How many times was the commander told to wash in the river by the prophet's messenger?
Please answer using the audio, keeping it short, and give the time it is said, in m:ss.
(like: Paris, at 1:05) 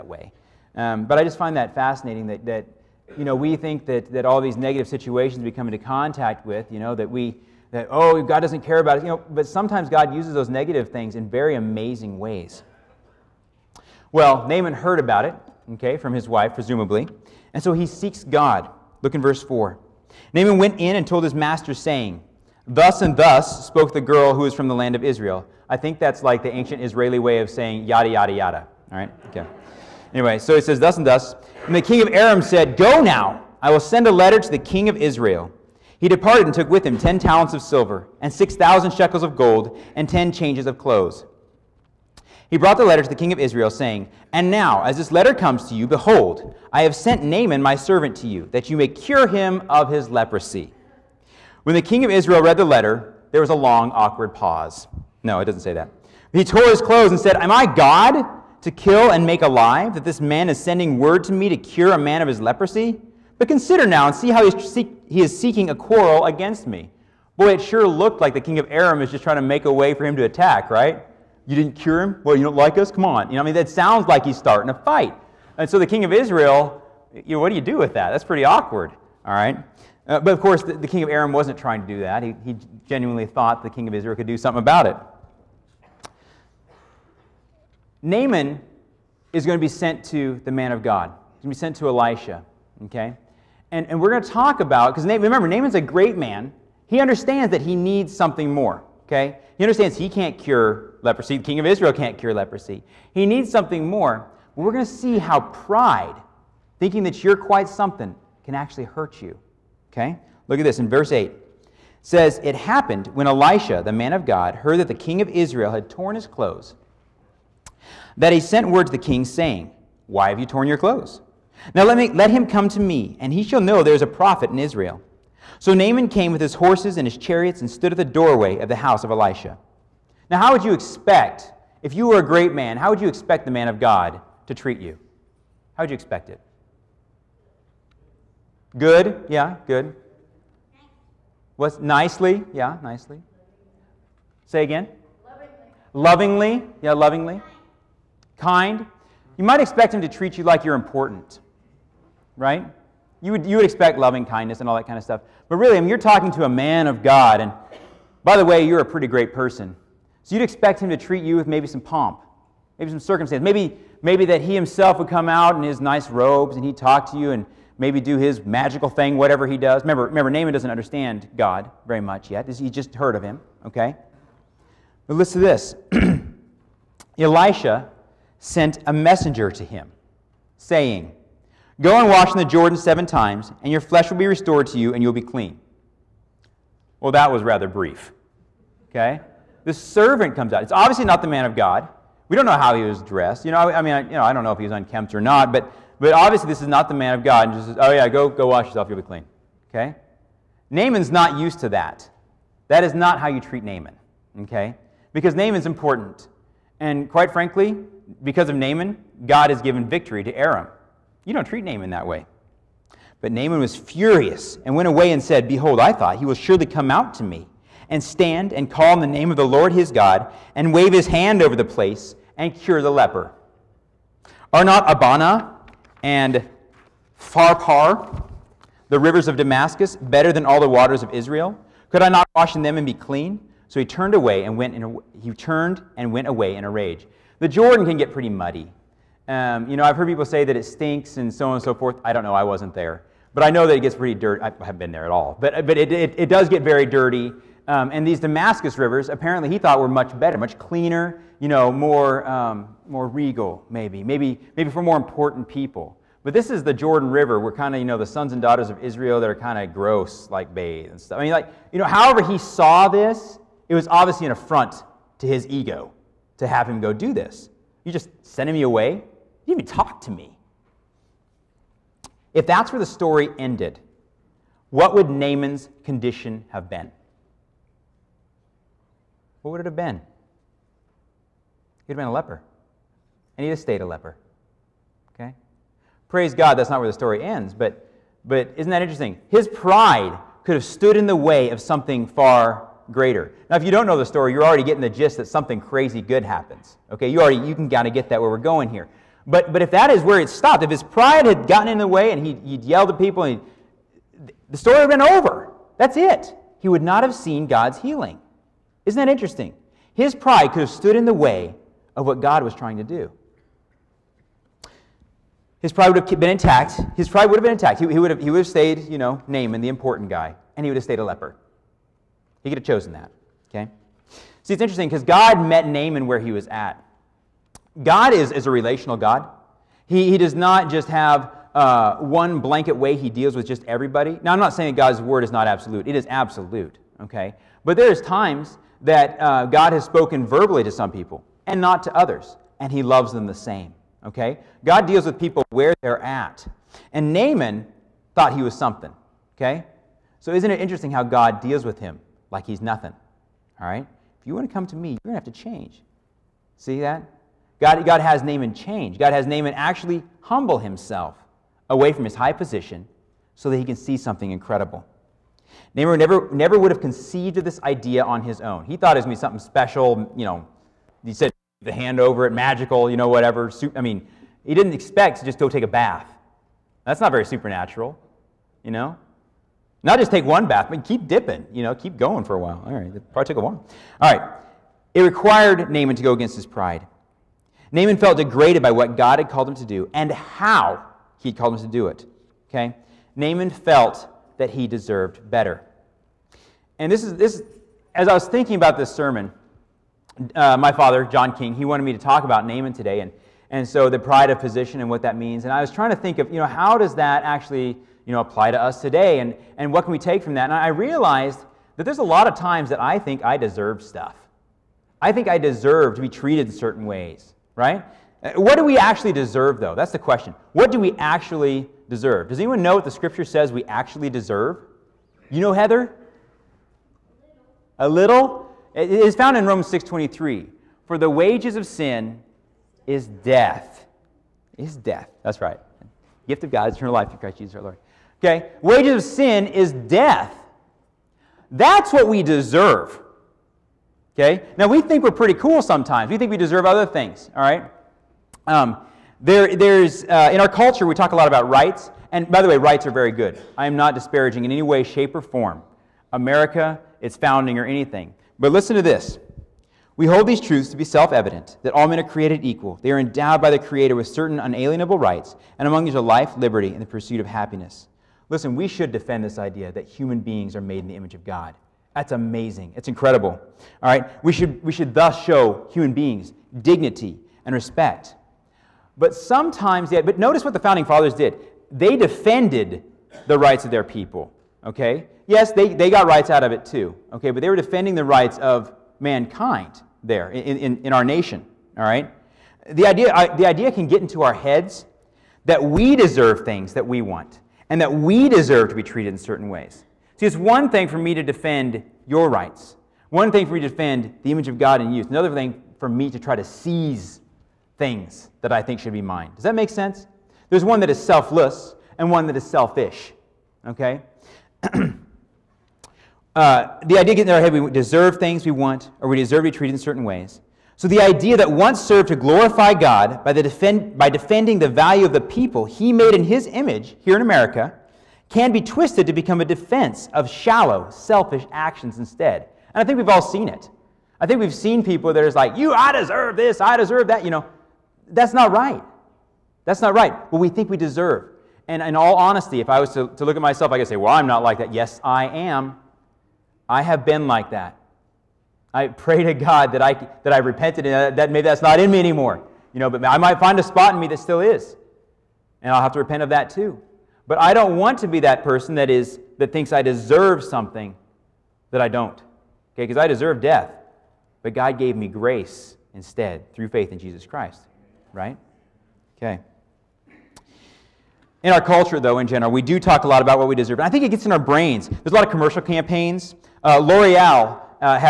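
7, at 3:02.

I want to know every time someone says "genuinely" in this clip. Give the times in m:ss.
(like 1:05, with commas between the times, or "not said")
1:22.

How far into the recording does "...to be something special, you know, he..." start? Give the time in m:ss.
6:09.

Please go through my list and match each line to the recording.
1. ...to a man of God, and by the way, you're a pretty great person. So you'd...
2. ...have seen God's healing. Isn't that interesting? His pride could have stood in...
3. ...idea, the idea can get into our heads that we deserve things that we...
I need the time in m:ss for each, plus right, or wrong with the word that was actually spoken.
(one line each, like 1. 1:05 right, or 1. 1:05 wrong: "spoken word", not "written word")
1. 2:36 right
2. 5:07 right
3. 8:12 right.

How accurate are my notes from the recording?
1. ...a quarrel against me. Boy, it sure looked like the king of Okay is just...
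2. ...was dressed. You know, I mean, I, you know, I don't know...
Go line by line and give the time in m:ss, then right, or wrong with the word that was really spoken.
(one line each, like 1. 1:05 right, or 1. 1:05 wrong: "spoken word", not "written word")
1. 1:05 wrong: "Aram", not "Okay"
2. 3:12 right.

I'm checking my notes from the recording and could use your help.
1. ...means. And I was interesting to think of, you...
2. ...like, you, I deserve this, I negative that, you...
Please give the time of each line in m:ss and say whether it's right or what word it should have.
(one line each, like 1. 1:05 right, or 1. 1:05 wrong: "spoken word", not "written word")
1. 6:45 wrong: "trying", not "interesting"
2. 8:55 wrong: "deserve", not "negative".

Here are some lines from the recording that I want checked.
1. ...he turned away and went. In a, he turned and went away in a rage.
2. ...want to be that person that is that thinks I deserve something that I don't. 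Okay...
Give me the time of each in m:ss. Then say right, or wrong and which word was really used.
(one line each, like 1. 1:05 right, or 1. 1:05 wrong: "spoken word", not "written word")
1. 3:53 right
2. 9:17 right.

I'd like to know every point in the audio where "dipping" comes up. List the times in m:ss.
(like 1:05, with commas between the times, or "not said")
6:21.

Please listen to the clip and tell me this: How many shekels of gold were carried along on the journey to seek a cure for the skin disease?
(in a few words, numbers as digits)
6000.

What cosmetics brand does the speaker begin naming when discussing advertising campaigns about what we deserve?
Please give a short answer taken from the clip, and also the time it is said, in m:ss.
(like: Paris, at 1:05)
L'Oreal, at 9:36.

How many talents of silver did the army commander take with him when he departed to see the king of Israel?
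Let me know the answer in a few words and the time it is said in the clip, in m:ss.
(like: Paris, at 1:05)
10, at 0:36.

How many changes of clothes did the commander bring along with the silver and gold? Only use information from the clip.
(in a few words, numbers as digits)
10.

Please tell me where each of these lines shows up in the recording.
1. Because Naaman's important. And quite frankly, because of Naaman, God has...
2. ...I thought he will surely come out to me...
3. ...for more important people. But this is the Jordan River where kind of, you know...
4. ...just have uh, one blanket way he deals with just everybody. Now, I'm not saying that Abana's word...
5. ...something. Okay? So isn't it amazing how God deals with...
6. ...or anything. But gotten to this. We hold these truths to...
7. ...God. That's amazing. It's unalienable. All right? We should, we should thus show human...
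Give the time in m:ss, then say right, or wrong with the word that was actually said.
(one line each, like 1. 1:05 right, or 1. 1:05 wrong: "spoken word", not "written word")
1. 3:25 right
2. 3:35 right
3. 4:14 right
4. 5:30 wrong: "God", not "Abana"
5. 5:48 wrong: "interesting", not "amazing"
6. 7:37 wrong: "listen", not "gotten"
7. 7:51 wrong: "incredible", not "unalienable".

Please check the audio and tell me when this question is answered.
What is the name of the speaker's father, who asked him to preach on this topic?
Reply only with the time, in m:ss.
6:41.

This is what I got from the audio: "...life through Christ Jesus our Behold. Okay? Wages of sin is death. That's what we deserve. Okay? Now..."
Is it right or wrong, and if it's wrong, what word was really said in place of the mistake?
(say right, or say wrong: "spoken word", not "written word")
wrong: "Lord", not "Behold".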